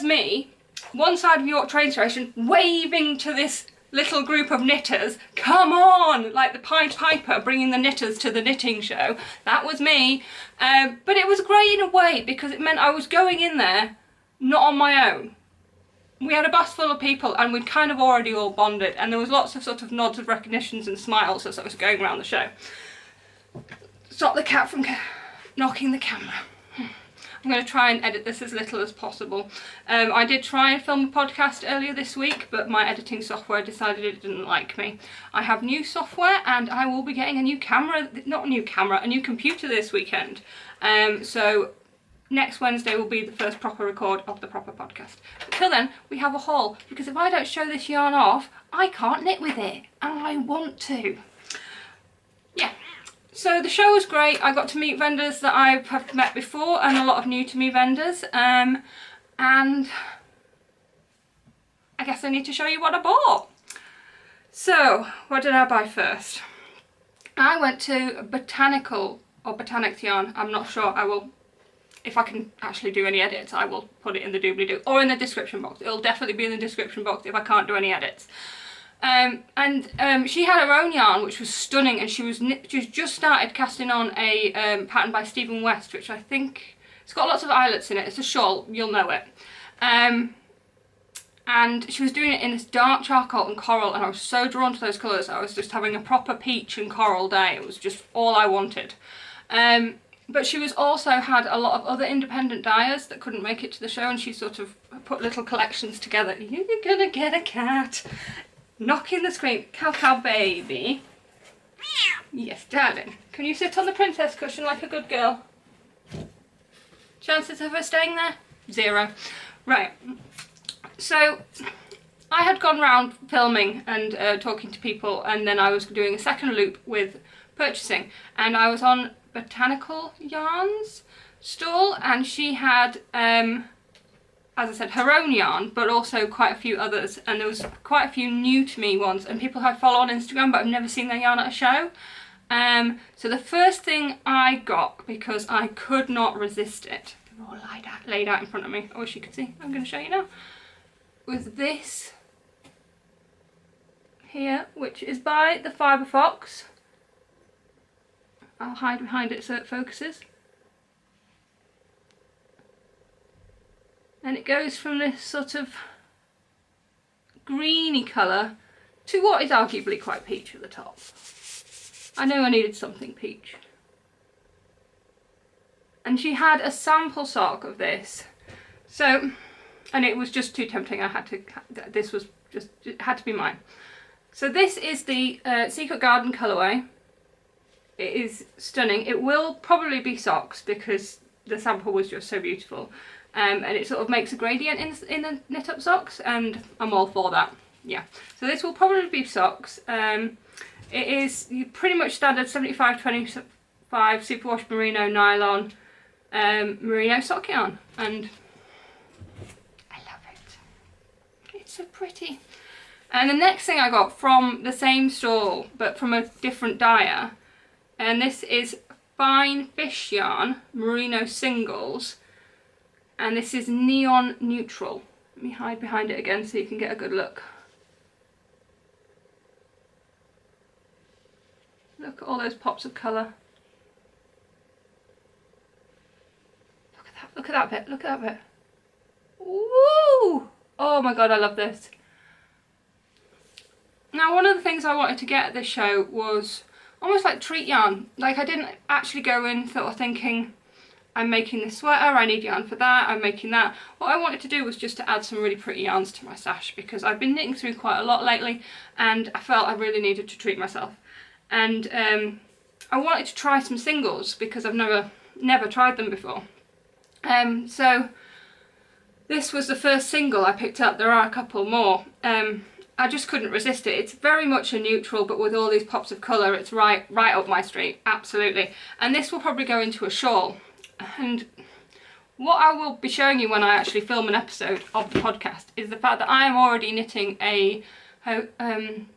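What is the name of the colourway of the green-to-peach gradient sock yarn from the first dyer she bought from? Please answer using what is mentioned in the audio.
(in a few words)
Secret Garden.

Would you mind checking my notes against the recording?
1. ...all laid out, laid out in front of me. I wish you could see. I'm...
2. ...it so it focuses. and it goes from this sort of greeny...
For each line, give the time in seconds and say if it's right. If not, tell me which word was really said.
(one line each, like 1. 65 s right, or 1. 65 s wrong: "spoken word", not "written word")
1. 147 s right
2. 159 s right.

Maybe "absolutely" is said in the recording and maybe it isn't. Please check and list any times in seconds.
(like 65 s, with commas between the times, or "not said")
278 s.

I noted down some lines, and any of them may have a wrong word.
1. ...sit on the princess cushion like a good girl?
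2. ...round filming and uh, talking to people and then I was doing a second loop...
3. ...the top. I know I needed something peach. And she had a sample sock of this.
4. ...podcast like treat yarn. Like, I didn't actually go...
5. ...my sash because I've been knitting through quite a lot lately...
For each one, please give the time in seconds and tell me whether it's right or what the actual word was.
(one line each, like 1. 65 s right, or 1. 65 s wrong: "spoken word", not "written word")
1. 113 s right
2. 122 s right
3. 170 s right
4. 247 s wrong: "almost", not "podcast"
5. 256 s right.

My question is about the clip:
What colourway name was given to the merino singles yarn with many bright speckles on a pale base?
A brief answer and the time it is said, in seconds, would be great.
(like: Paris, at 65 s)
Neon Neutral, at 223 s.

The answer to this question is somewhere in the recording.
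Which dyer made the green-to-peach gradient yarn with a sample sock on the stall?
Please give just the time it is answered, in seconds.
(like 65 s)
155 s.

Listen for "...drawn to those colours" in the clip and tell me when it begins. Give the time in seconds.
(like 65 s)
94 s.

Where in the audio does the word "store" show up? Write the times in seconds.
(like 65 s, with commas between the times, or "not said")
215 s.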